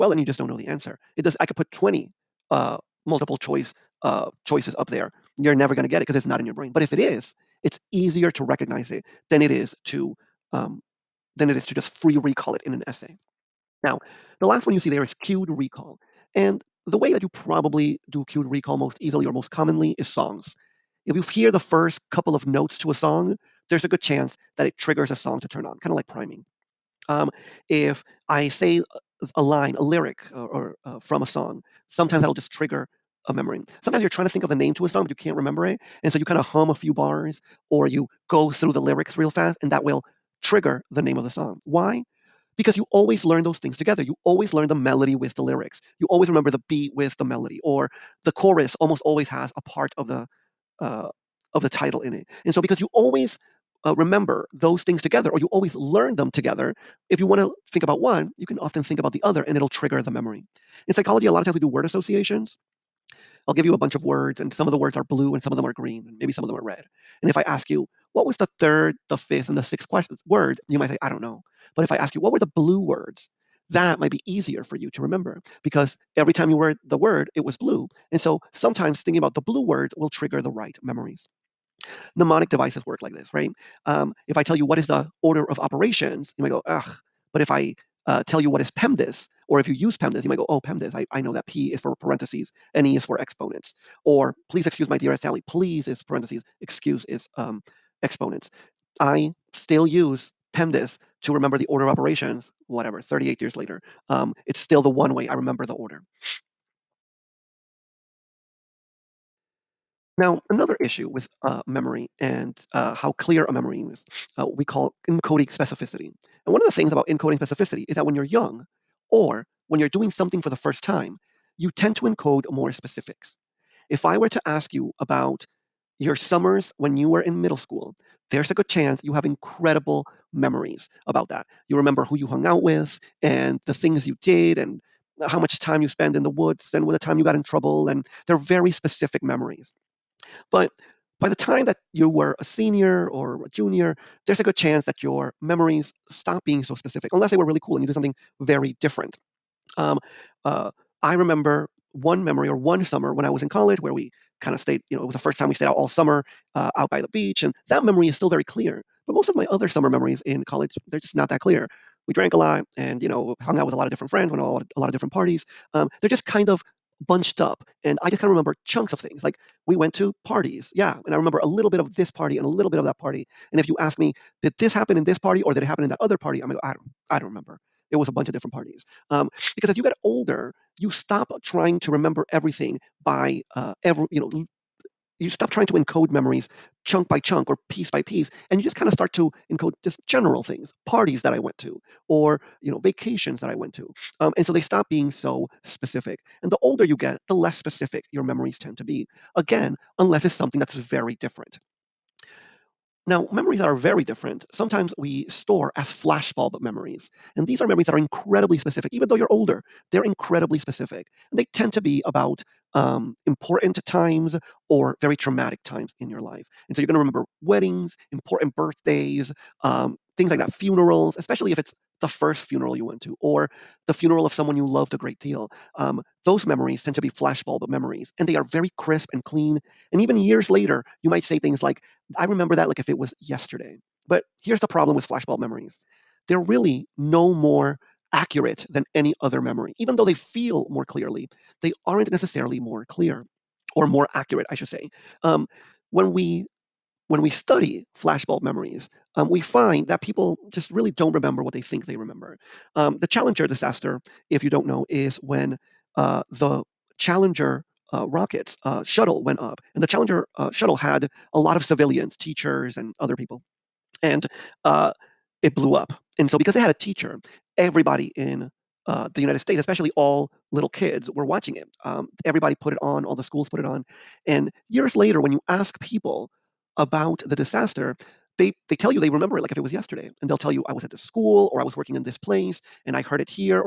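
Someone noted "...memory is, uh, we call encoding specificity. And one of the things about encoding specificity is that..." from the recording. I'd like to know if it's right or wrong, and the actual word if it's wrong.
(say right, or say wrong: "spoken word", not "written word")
right.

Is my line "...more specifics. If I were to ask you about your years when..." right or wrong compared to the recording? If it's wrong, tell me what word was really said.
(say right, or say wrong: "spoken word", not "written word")
wrong: "summers", not "years".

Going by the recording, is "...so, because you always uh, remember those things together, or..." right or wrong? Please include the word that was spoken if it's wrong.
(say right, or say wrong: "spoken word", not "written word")
right.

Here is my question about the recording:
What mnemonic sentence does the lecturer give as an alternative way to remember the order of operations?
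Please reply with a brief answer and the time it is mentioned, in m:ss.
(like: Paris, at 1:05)
Please excuse my dear Sally, at 1:34.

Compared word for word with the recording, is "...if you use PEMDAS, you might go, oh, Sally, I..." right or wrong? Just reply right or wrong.
wrong.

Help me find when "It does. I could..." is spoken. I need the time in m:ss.
0:01.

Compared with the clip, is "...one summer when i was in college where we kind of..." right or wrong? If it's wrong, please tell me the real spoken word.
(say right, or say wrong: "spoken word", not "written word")
right.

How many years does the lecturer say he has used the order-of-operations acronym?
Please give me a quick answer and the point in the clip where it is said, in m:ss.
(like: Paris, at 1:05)
38, at 1:43.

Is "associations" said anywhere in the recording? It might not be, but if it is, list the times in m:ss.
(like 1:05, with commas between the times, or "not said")
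1:01.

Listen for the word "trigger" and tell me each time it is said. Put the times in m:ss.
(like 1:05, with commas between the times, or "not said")
0:24, 0:32, 0:40, 0:59, 1:20.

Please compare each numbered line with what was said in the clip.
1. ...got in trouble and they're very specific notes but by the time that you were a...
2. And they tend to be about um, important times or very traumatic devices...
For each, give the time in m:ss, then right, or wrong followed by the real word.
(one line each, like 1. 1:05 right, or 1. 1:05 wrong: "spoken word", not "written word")
1. 2:17 wrong: "memories", not "notes"
2. 3:31 wrong: "times", not "devices".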